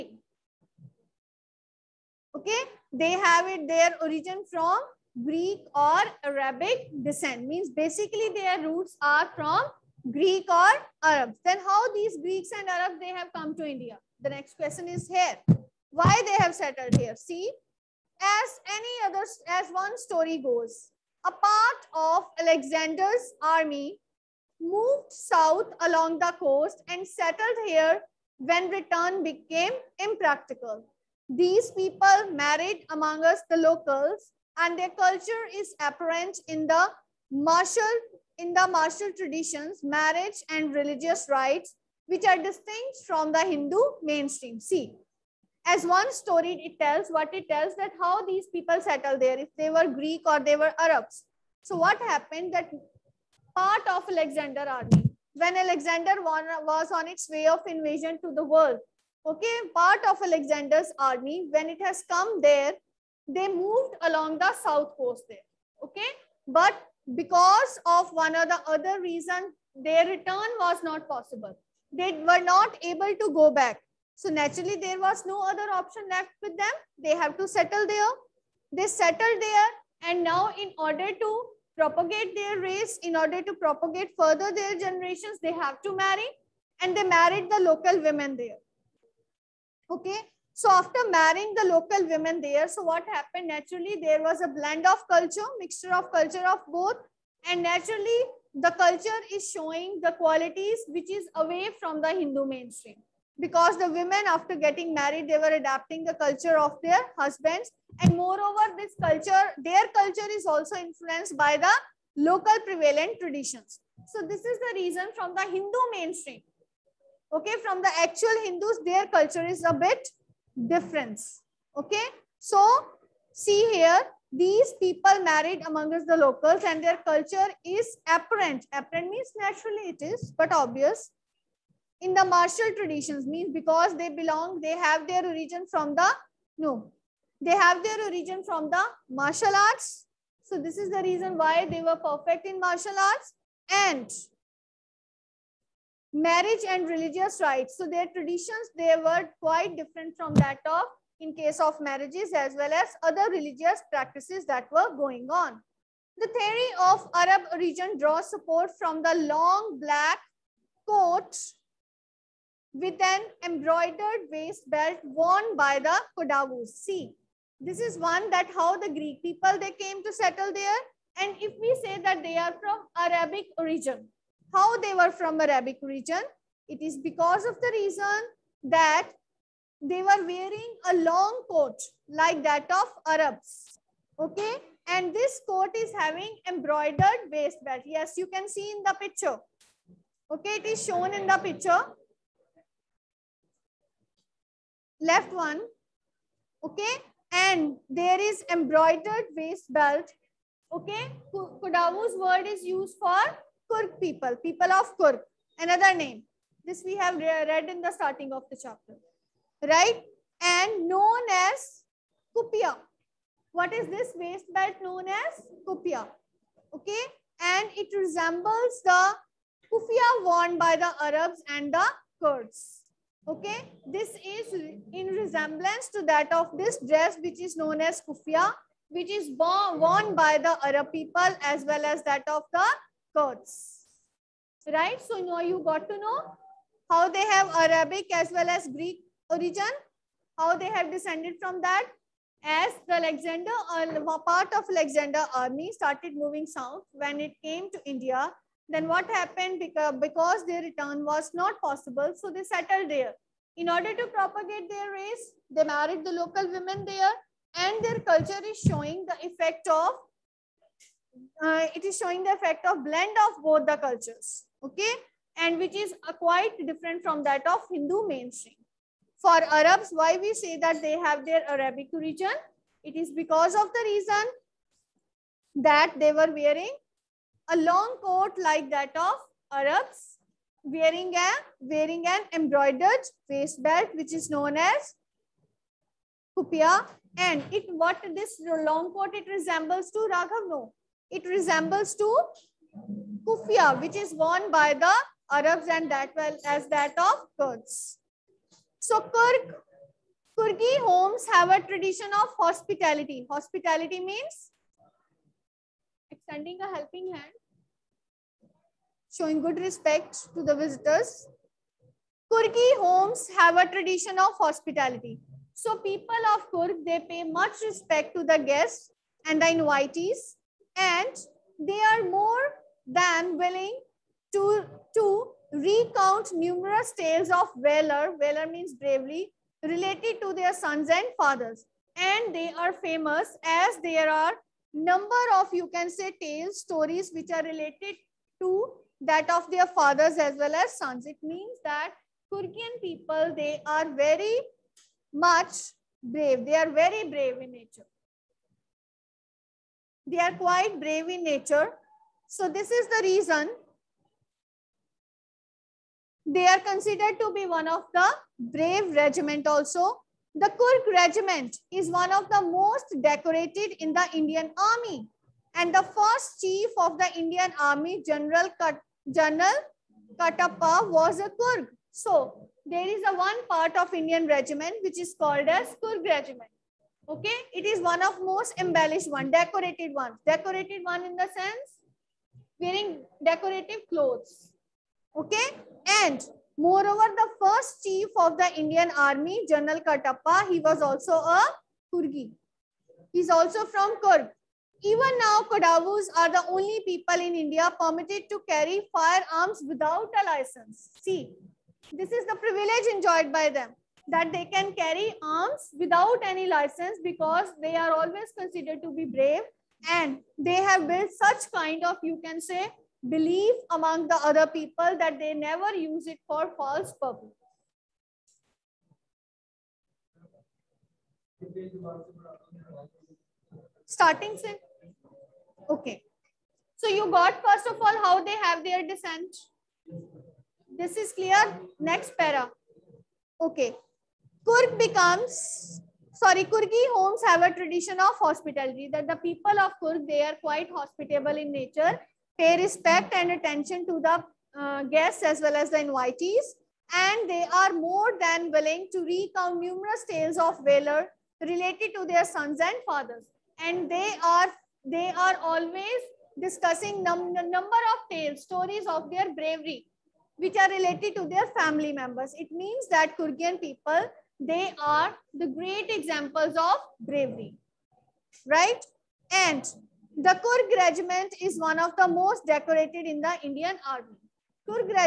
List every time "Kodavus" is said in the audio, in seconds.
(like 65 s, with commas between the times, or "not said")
166 s, 201 s, 395 s.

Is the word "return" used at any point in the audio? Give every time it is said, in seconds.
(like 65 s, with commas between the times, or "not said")
28 s, 70 s, 250 s.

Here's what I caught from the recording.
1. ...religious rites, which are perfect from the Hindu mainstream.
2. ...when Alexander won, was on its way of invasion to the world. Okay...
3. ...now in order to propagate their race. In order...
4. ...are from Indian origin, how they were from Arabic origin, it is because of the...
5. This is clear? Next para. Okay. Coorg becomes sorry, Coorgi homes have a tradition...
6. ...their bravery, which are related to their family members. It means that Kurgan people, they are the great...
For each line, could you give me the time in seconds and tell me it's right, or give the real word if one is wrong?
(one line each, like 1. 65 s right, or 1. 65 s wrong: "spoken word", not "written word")
1. 40 s wrong: "distinct", not "perfect"
2. 55 s right
3. 80 s right
4. 172 s wrong: "Arabic", not "Indian"
5. 430 s right
6. 459 s right.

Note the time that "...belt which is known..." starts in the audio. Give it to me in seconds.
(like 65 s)
283 s.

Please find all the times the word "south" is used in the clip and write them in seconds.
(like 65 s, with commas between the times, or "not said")
25 s, 64 s, 246 s.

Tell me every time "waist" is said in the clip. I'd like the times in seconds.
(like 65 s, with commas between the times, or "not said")
164 s, 187 s, 199 s, 214 s.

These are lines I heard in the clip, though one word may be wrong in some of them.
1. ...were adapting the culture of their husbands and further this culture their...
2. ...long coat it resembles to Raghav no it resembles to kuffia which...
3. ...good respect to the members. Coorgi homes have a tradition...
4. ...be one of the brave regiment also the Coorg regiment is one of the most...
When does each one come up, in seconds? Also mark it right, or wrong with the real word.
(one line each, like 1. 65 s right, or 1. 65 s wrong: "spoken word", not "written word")
1. 105 s wrong: "moreover", not "further"
2. 288 s right
3. 309 s wrong: "visitors", not "members"
4. 357 s right.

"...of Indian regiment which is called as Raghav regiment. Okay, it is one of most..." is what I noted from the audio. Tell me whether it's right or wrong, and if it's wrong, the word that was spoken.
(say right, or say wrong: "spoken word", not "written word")
wrong: "Coorg", not "Raghav".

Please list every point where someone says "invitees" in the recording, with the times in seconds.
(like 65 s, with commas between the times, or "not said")
319 s, 445 s.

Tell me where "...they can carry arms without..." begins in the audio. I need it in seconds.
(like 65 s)
404 s.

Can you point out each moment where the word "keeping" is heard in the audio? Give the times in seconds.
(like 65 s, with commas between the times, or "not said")
not said.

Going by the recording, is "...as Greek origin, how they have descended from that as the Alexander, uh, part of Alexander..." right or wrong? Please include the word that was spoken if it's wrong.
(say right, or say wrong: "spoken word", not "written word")
right.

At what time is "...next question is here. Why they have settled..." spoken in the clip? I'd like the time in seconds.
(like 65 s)
14 s.